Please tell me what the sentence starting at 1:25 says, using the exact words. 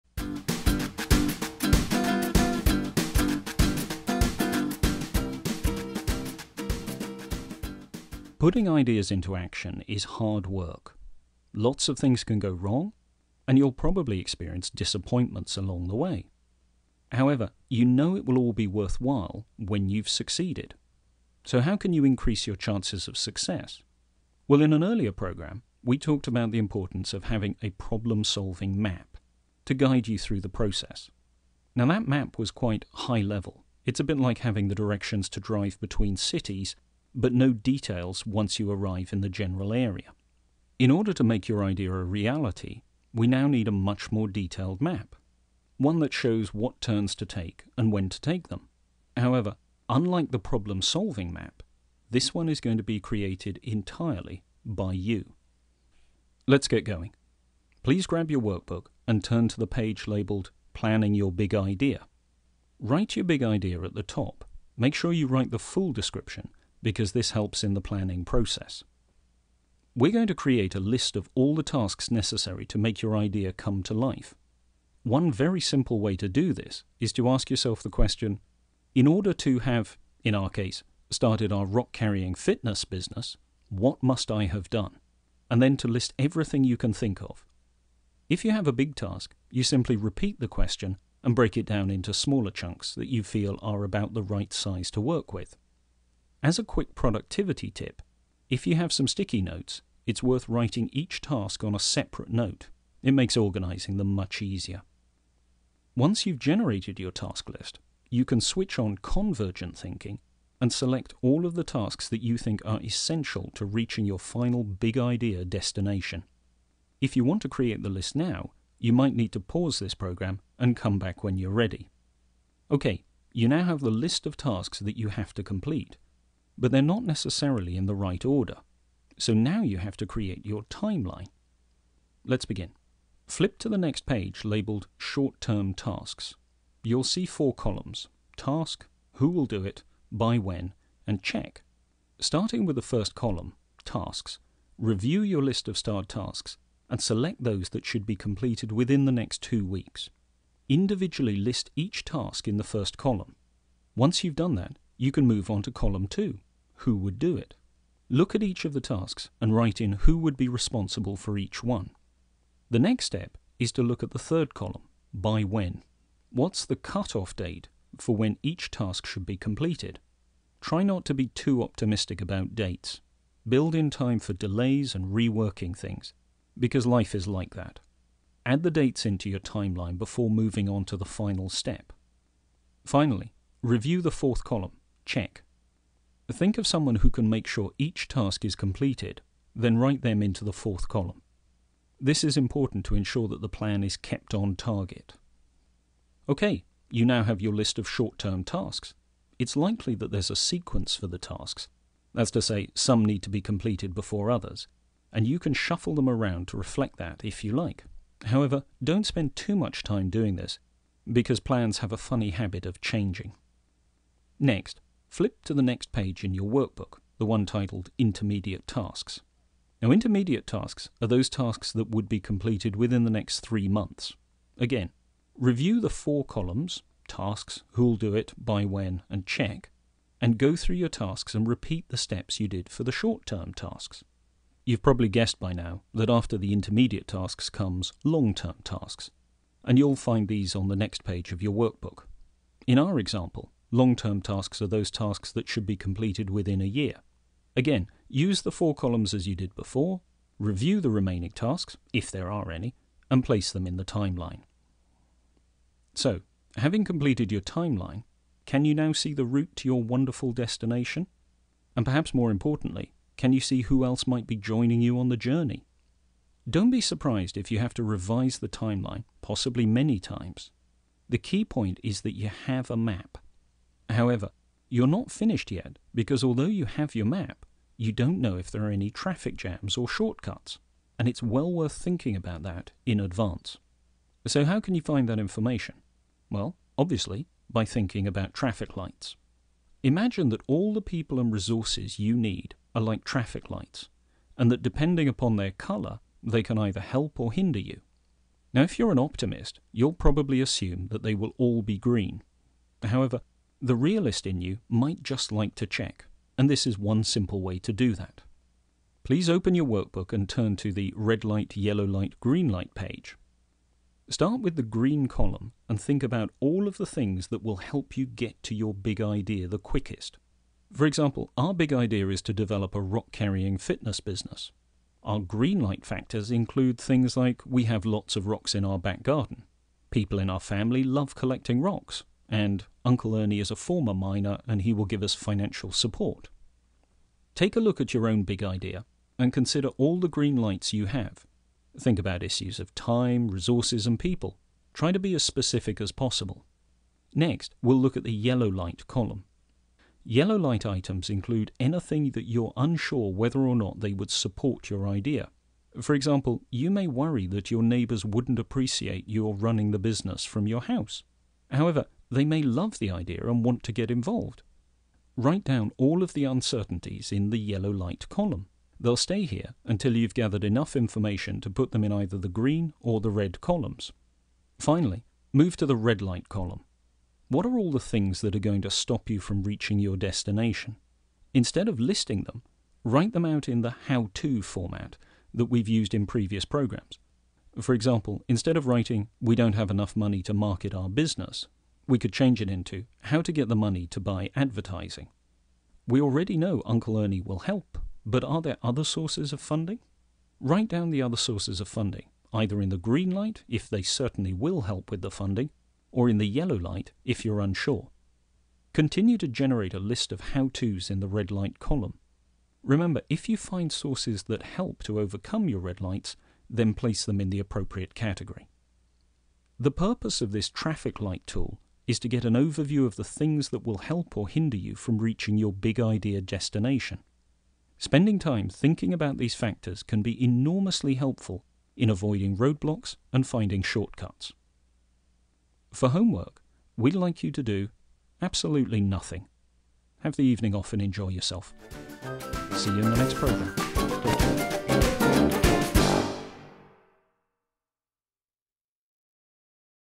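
And then to list everything you can think of.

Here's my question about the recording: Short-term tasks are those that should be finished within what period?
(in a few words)
two weeks.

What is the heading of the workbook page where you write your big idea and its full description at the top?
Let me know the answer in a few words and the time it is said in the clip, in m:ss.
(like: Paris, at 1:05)
Planning Your Big Idea, at 1:00.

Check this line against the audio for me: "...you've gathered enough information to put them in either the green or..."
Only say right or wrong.
right.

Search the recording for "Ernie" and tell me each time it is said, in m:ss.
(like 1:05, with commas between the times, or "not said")
5:33, 6:36.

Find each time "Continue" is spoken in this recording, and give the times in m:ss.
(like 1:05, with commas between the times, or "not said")
6:48.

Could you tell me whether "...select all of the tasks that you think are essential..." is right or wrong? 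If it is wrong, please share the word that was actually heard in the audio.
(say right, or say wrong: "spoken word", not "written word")
right.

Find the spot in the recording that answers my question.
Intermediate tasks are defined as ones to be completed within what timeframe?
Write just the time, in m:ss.
3:43.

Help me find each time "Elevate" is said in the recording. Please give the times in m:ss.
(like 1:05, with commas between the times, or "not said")
not said.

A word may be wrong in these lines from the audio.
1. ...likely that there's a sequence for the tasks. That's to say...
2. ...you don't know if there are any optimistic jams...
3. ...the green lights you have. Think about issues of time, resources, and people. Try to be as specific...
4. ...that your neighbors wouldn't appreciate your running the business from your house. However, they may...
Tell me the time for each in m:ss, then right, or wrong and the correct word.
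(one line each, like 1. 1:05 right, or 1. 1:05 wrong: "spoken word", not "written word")
1. 3:19 right
2. 4:37 wrong: "traffic", not "optimistic"
3. 5:39 right
4. 5:57 right.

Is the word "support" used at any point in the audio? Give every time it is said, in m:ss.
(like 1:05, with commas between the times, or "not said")
5:35, 5:54.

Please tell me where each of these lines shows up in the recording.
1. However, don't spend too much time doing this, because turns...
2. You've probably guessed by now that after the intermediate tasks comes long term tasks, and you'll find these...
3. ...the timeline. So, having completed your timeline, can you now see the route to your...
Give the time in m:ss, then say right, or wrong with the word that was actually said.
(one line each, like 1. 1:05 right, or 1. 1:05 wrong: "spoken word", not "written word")
1. 3:28 wrong: "plans", not "turns"
2. 3:54 right
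3. 4:13 right.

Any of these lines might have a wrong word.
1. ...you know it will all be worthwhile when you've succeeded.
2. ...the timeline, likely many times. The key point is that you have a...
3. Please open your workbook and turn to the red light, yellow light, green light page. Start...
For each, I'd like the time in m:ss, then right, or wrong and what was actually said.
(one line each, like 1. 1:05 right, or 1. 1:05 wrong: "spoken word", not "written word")
1. 0:17 right
2. 4:28 wrong: "possibly", not "likely"
3. 5:09 right.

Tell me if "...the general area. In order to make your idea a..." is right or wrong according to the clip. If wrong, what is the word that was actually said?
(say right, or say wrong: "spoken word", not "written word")
right.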